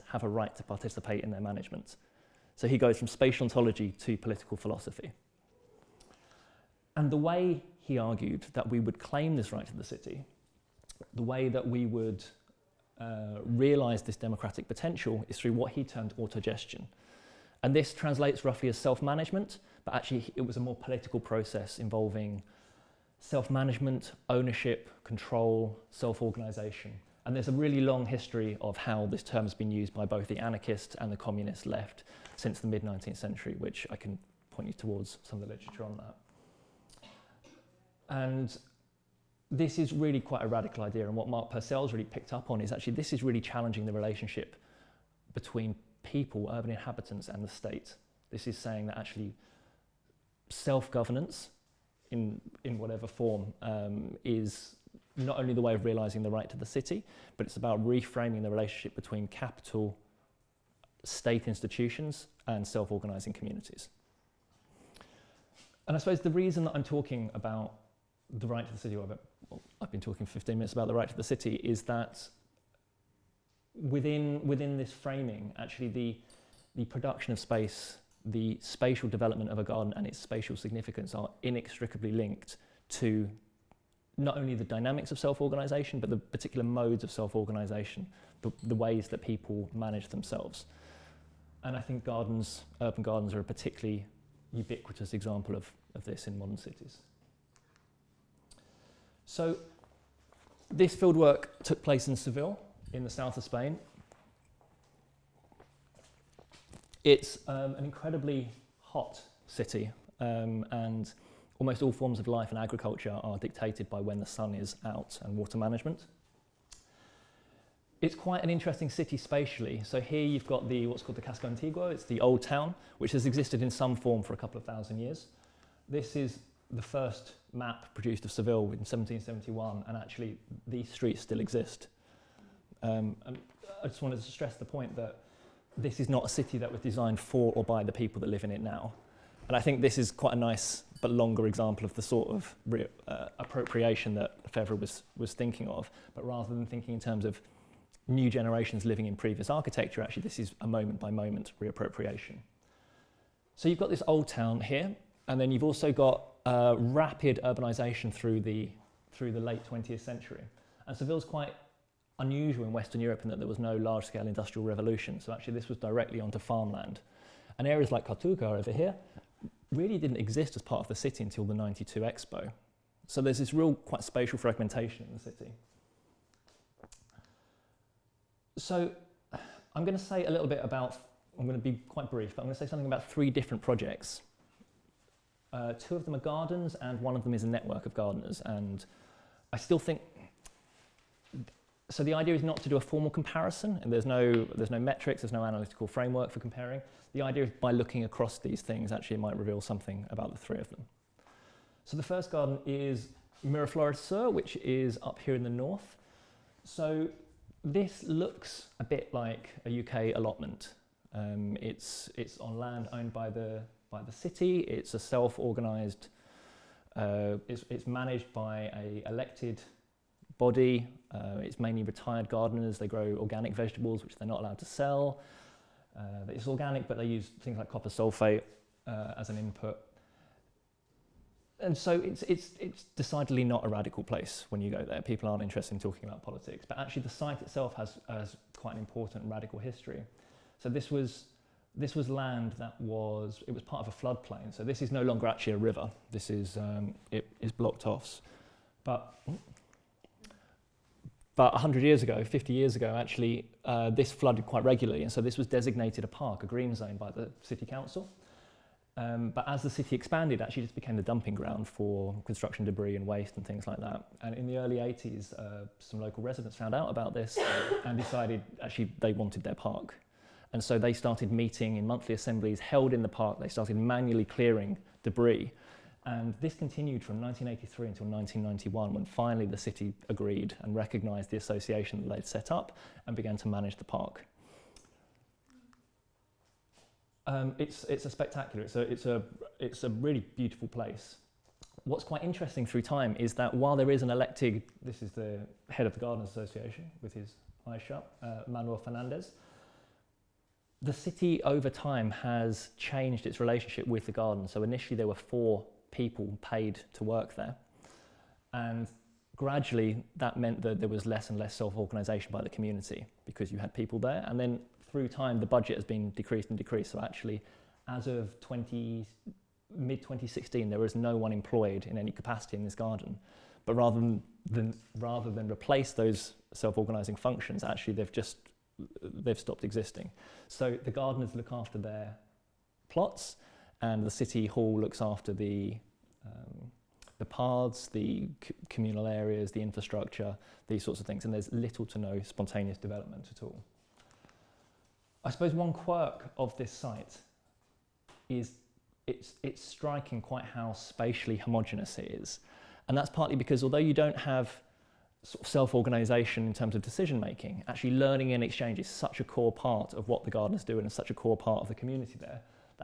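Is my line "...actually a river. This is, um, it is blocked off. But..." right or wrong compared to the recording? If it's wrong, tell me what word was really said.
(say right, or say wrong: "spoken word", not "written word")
right.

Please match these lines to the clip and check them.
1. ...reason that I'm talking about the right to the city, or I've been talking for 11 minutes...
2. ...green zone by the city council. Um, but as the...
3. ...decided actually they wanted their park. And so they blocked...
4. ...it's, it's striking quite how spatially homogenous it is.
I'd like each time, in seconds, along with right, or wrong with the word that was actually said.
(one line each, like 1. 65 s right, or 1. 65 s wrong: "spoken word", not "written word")
1. 66 s wrong: "15", not "11"
2. 256 s right
3. 267 s wrong: "started", not "blocked"
4. 349 s right.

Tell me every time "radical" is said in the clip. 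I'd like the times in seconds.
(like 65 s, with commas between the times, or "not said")
40 s, 233 s, 239 s.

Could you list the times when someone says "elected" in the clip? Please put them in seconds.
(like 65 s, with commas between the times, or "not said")
219 s, 294 s.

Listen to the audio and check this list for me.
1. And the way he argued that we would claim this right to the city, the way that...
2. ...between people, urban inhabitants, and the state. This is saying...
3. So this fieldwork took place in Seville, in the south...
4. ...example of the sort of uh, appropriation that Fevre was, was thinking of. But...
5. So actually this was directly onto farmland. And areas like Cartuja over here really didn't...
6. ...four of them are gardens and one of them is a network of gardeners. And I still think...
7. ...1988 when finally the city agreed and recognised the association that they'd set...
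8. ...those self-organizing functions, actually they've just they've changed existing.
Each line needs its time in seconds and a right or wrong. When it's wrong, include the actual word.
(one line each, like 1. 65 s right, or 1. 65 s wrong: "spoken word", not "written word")
1. 6 s right
2. 45 s right
3. 99 s right
4. 141 s right
5. 165 s right
6. 185 s wrong: "two", not "four"
7. 278 s wrong: "1991", not "1988"
8. 325 s wrong: "stopped", not "changed".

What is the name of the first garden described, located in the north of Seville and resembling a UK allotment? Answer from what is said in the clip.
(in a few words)
Miraflores Sur.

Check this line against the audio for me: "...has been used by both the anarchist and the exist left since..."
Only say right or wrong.
wrong.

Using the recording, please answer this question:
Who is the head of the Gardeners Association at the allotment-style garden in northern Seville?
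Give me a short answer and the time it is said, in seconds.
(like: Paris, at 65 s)
Manuel Fernandez, at 298 s.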